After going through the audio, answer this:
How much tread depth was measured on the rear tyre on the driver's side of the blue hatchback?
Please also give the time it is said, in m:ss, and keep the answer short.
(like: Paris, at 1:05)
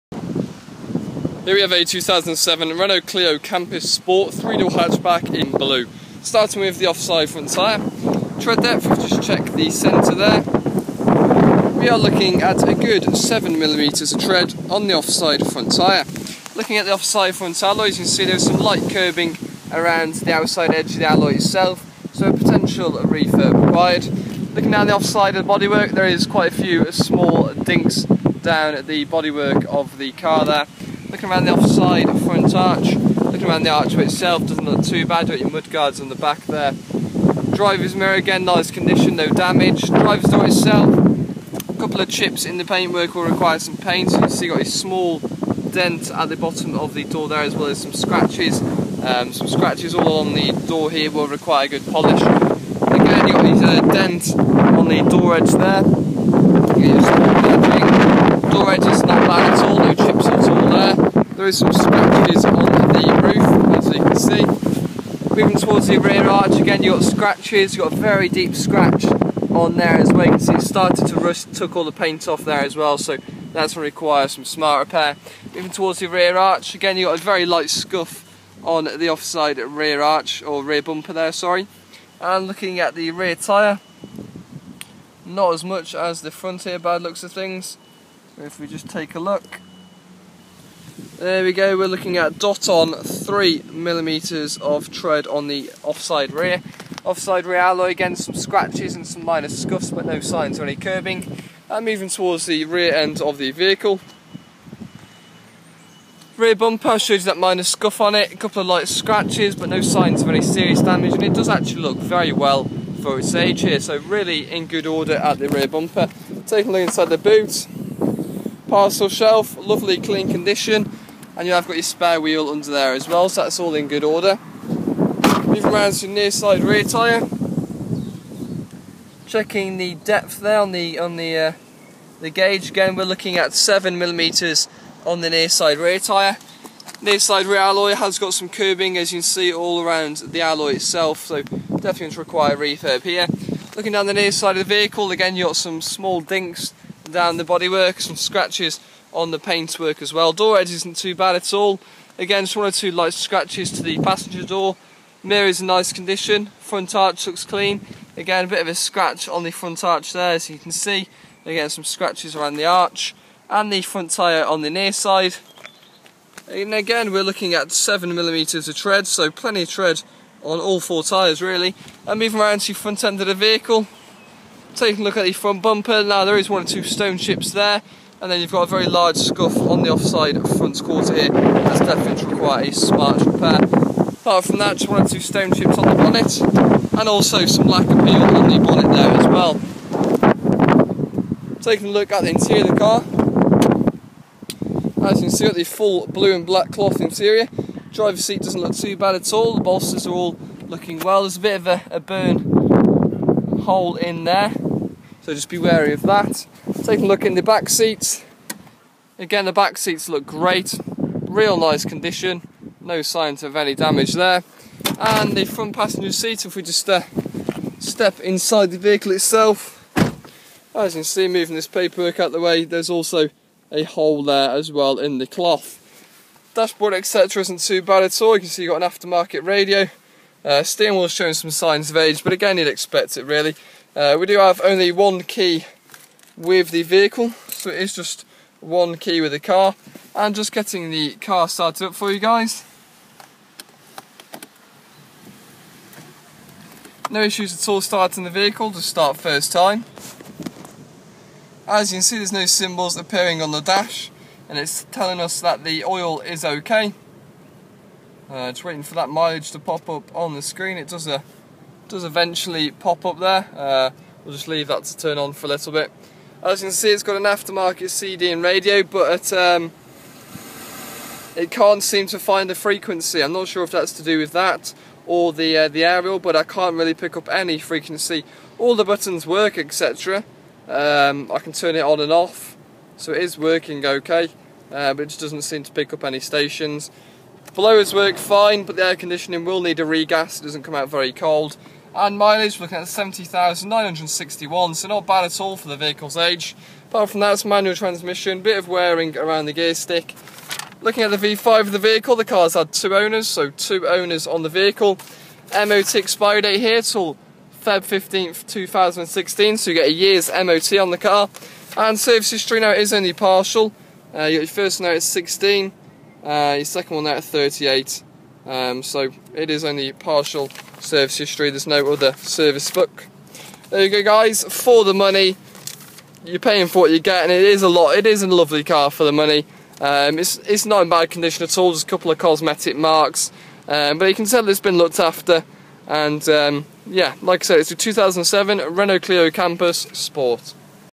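3 millimeters, at 1:32.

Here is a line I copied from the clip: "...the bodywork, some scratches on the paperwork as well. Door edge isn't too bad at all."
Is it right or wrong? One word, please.
wrong.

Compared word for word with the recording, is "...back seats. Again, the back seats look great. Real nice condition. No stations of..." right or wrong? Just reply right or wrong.
wrong.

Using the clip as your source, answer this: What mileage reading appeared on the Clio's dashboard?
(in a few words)
70,961.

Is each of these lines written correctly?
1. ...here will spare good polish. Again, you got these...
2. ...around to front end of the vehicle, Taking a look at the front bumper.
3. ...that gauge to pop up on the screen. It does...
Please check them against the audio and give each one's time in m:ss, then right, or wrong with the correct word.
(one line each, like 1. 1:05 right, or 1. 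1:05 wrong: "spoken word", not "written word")
1. 0:50 wrong: "require", not "spare"
2. 2:52 right
3. 4:18 wrong: "mileage", not "gauge".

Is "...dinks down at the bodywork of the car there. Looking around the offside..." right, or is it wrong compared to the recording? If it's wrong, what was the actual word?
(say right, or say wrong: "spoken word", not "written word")
right.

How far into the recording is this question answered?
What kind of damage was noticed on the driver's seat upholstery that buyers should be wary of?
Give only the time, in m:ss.
3:21.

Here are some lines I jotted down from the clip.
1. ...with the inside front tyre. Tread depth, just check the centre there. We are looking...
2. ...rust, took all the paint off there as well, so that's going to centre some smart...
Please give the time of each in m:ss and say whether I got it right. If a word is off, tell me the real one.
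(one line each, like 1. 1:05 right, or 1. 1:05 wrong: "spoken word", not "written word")
1. 0:06 wrong: "offside", not "inside"
2. 1:11 wrong: "require", not "centre".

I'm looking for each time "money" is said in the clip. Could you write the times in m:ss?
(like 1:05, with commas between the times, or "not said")
5:24, 5:29.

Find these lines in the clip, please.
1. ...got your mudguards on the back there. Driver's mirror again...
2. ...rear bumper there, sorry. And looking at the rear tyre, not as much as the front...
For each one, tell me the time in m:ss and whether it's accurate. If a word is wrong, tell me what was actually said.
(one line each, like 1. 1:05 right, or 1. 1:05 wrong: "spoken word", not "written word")
1. 0:35 right
2. 1:20 right.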